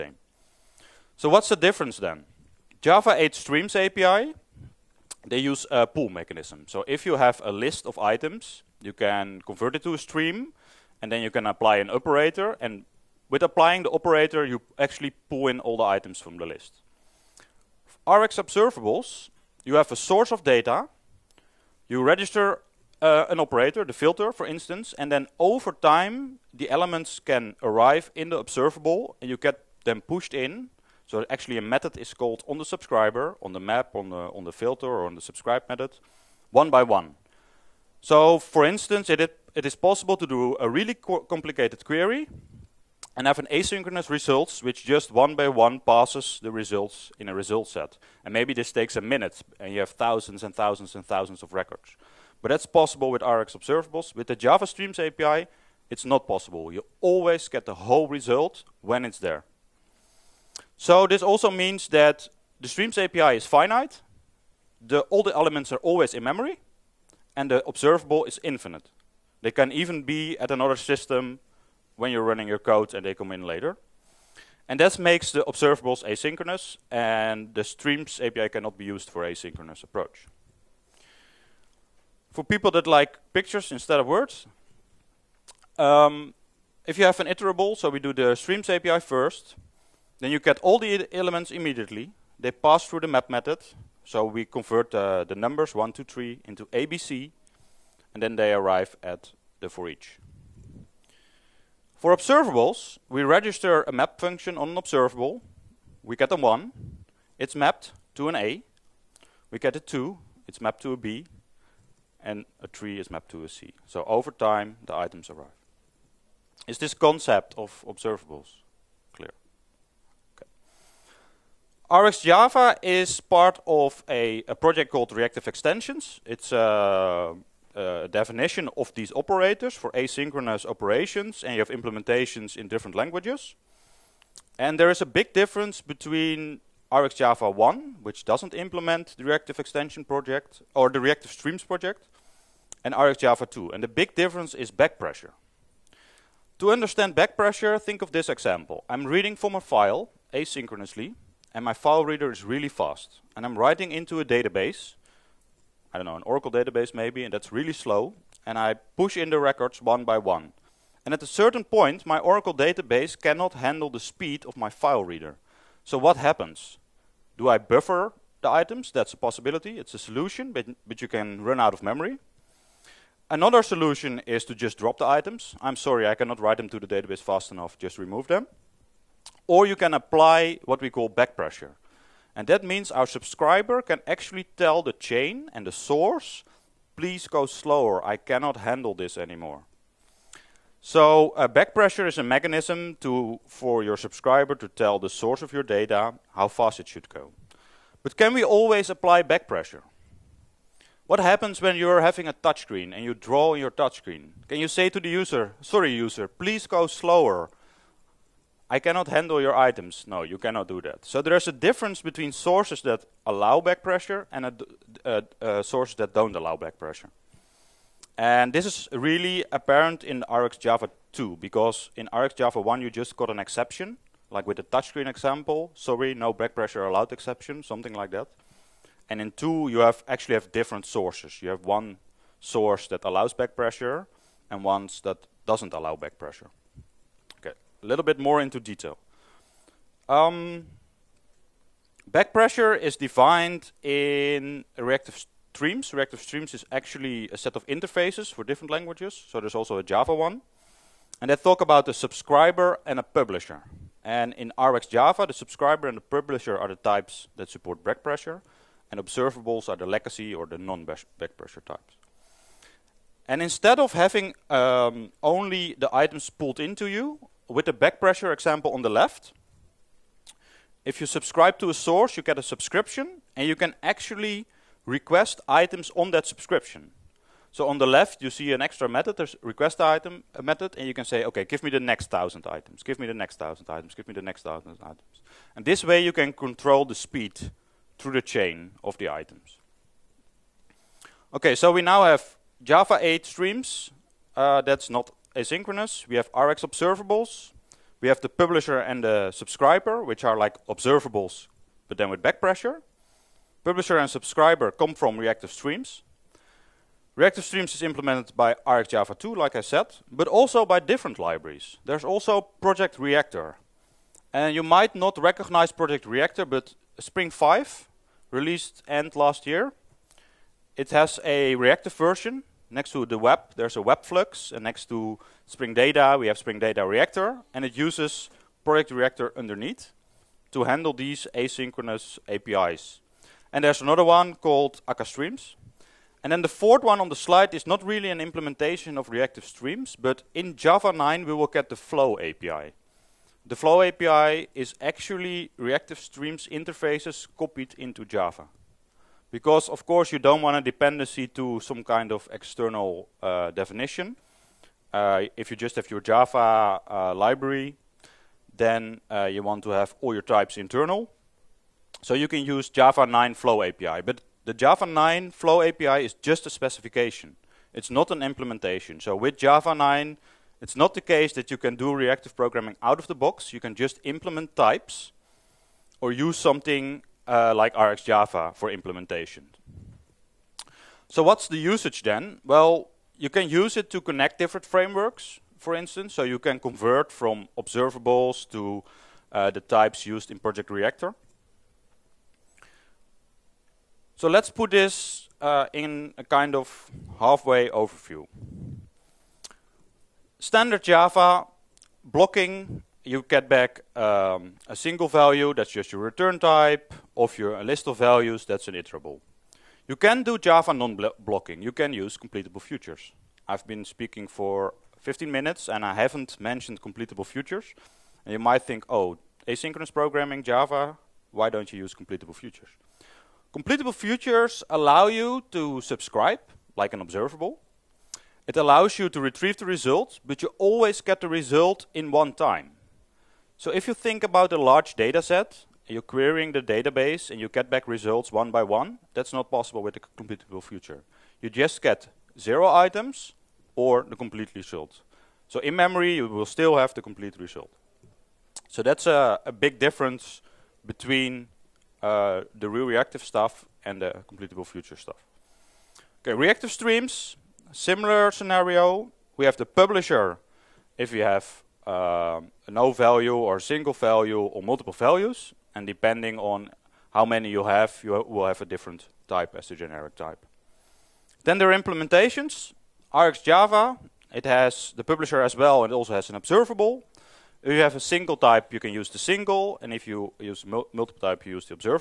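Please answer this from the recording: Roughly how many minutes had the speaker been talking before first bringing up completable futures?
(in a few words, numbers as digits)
15.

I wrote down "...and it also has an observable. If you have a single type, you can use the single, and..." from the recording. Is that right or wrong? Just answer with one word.
right.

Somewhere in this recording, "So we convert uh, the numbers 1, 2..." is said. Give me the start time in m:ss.
1:34.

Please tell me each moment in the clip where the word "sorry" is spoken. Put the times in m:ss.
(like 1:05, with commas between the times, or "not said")
2:55, 3:25, 3:45.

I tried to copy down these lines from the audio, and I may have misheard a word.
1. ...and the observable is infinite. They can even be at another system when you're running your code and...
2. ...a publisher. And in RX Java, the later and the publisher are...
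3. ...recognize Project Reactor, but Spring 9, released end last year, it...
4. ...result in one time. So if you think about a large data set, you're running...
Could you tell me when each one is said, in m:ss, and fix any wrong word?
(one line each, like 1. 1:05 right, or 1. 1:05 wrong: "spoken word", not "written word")
1. 1:07 right
2. 4:12 wrong: "subscriber", not "later"
3. 5:15 wrong: "5", not "9"
4. 7:11 wrong: "querying", not "running".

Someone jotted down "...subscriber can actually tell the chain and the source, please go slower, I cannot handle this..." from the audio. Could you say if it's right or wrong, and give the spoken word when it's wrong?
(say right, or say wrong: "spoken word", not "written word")
right.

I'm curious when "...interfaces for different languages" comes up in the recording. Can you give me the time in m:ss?
4:07.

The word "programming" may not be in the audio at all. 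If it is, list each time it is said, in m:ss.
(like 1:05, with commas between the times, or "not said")
6:12, 6:59.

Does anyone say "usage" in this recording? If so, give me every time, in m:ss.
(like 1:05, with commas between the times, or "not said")
6:21.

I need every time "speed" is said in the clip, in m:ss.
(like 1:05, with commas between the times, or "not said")
2:43, 4:46.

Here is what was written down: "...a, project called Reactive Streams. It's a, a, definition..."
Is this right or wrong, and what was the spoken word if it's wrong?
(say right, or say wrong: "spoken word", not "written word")
wrong: "Extensions", not "Streams".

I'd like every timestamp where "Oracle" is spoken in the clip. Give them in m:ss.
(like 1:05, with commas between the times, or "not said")
2:36, 2:42.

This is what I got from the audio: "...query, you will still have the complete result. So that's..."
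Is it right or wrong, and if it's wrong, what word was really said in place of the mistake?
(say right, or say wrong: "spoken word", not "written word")
wrong: "memory", not "query".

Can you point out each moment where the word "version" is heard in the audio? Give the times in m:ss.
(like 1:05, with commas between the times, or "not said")
5:21.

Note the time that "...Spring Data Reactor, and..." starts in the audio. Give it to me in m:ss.
5:26.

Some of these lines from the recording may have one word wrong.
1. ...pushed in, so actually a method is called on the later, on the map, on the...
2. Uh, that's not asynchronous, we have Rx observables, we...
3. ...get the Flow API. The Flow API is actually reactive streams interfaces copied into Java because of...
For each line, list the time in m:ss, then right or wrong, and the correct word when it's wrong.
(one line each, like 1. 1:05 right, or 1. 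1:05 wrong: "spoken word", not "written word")
1. 0:30 wrong: "subscriber", not "later"
2. 4:54 right
3. 5:41 right.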